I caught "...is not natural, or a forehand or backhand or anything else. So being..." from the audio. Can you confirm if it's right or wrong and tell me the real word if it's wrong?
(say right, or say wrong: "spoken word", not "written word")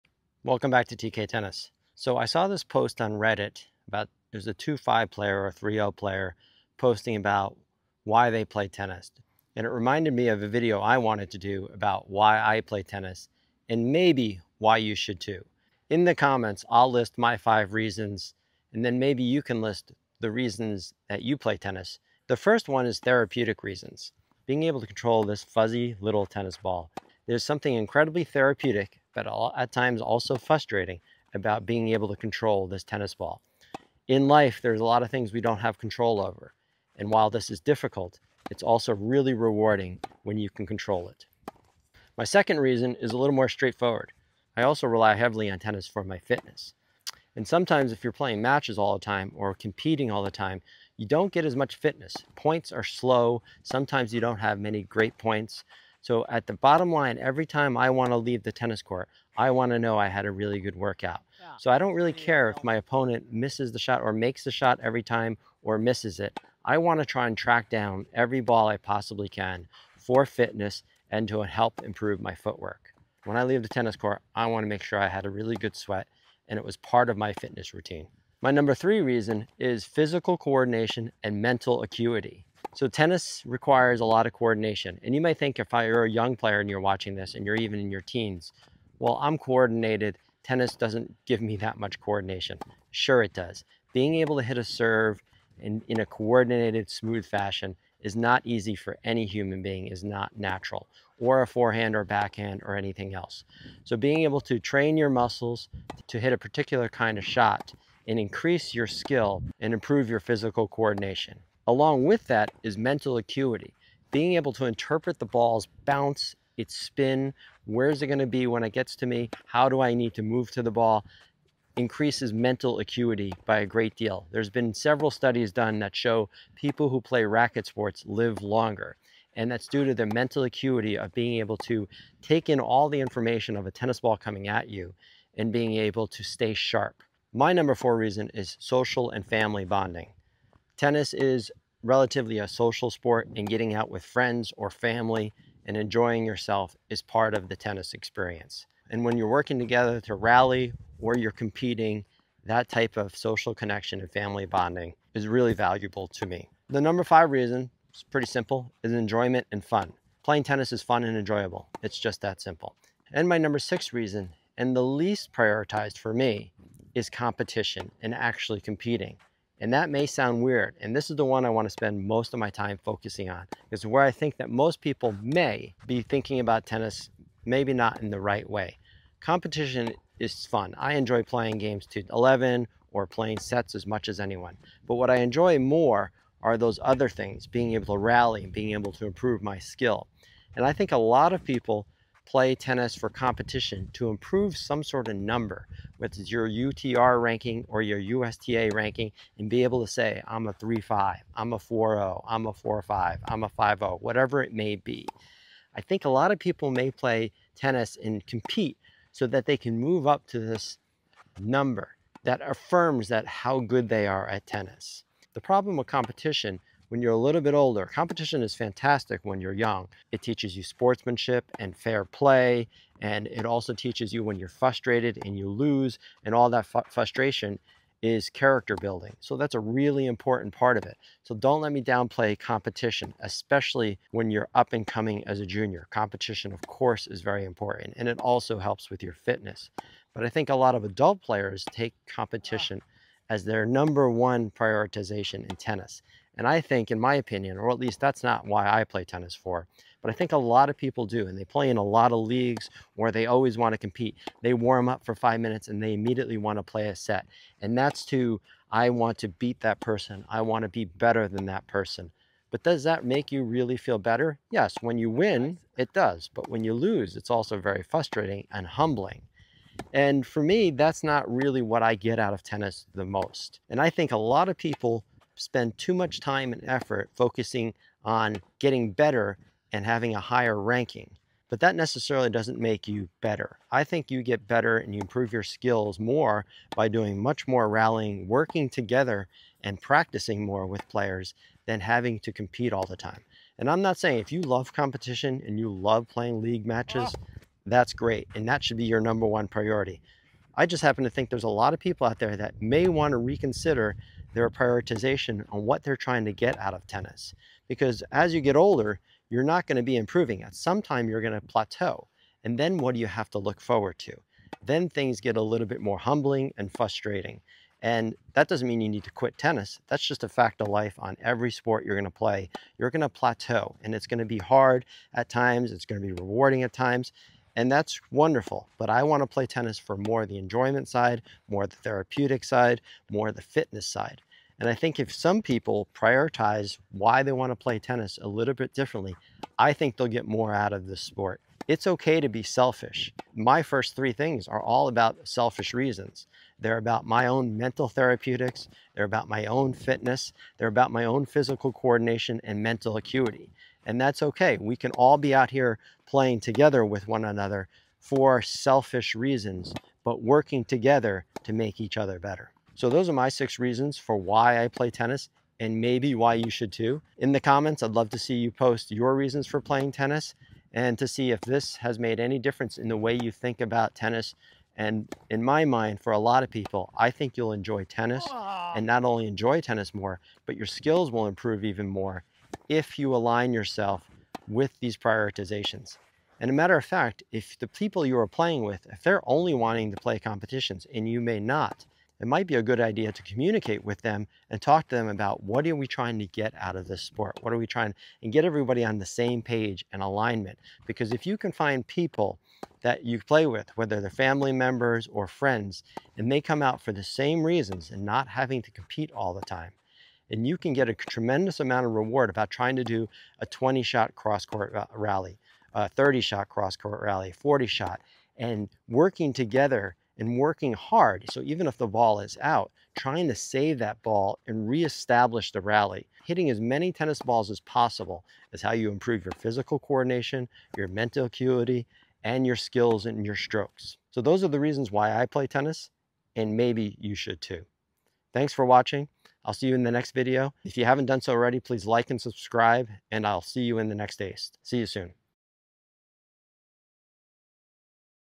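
right.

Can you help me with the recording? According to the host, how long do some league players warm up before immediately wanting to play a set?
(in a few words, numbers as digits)
5 minutes.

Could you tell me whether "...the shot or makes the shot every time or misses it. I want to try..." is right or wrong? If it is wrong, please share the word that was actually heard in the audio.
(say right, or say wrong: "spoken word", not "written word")
right.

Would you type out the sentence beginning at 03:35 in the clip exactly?
The problem with competition when you're a little bit older.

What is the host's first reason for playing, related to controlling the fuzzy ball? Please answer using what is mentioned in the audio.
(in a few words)
Therapeutic reasons.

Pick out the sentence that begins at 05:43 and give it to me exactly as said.
My first three things are all about selfish reasons.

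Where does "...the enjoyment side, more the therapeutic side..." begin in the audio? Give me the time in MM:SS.
05:30.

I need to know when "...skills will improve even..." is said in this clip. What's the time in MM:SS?
06:20.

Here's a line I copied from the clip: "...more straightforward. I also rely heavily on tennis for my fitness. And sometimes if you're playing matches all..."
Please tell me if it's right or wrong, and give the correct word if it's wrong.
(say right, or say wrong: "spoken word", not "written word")
right.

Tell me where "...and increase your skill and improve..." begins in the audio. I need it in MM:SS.
01:48.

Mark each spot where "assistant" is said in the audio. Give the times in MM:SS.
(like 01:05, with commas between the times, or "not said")
not said.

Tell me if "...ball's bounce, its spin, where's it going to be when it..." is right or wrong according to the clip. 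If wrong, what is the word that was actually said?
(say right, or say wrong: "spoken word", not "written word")
right.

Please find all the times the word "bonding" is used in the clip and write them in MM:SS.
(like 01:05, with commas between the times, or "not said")
02:19, 02:34.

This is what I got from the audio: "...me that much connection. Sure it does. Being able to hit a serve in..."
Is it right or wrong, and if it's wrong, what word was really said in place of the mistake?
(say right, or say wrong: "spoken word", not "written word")
wrong: "coordination", not "connection".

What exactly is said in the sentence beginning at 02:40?
Playing tennis is fun and enjoyable.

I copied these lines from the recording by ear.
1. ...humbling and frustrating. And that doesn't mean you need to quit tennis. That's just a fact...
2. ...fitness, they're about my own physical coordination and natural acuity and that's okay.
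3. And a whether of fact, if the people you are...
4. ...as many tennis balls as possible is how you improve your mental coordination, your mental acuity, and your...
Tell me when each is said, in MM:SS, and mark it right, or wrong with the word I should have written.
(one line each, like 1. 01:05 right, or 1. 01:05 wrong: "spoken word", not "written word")
1. 05:15 right
2. 05:49 wrong: "mental", not "natural"
3. 06:26 wrong: "matter", not "whether"
4. 07:06 wrong: "physical", not "mental".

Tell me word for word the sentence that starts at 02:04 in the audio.
There's been several studies done that show people who play racket sports live longer.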